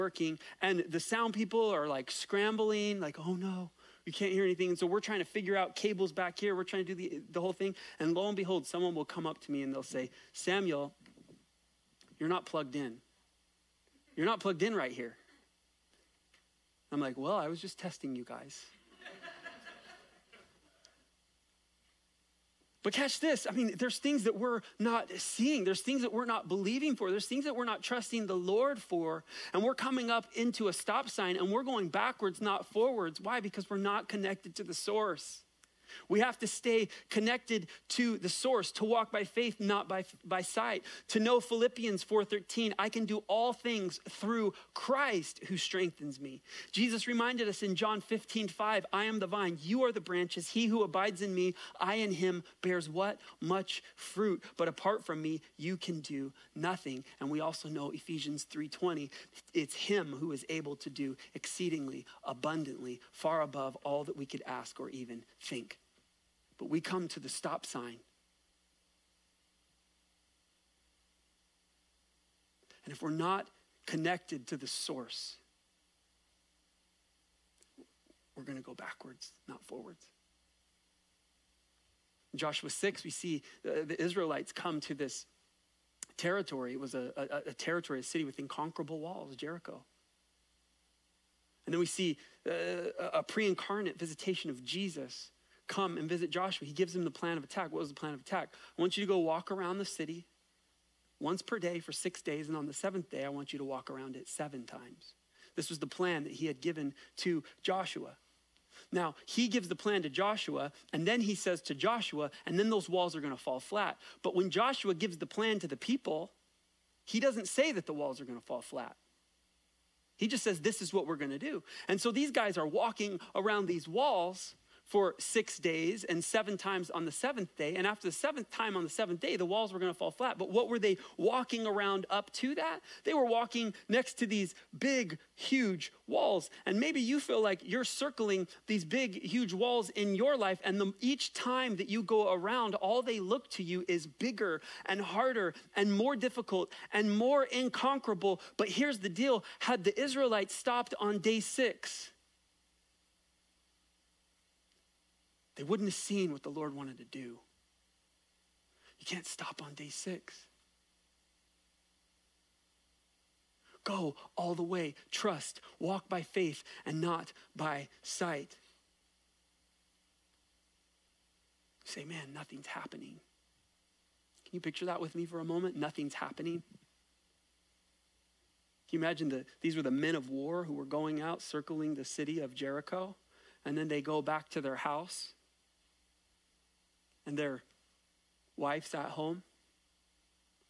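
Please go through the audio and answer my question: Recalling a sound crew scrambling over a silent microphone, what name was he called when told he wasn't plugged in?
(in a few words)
Samuel.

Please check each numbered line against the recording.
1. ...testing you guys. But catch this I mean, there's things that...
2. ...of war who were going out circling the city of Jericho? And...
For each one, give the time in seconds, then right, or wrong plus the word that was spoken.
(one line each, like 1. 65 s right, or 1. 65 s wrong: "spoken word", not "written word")
1. 17 s right
2. 180 s right.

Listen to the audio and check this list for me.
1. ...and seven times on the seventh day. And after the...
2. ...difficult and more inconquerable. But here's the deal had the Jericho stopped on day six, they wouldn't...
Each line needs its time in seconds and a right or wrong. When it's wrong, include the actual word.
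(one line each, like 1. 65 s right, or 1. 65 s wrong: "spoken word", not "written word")
1. 126 s right
2. 146 s wrong: "Israelites", not "Jericho".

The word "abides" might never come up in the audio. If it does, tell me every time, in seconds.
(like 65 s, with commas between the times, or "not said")
50 s.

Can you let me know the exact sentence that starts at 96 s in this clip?
He gives him the plan of attack.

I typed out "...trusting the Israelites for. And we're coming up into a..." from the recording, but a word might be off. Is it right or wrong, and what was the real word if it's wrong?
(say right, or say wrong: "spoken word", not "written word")
wrong: "Lord", not "Israelites".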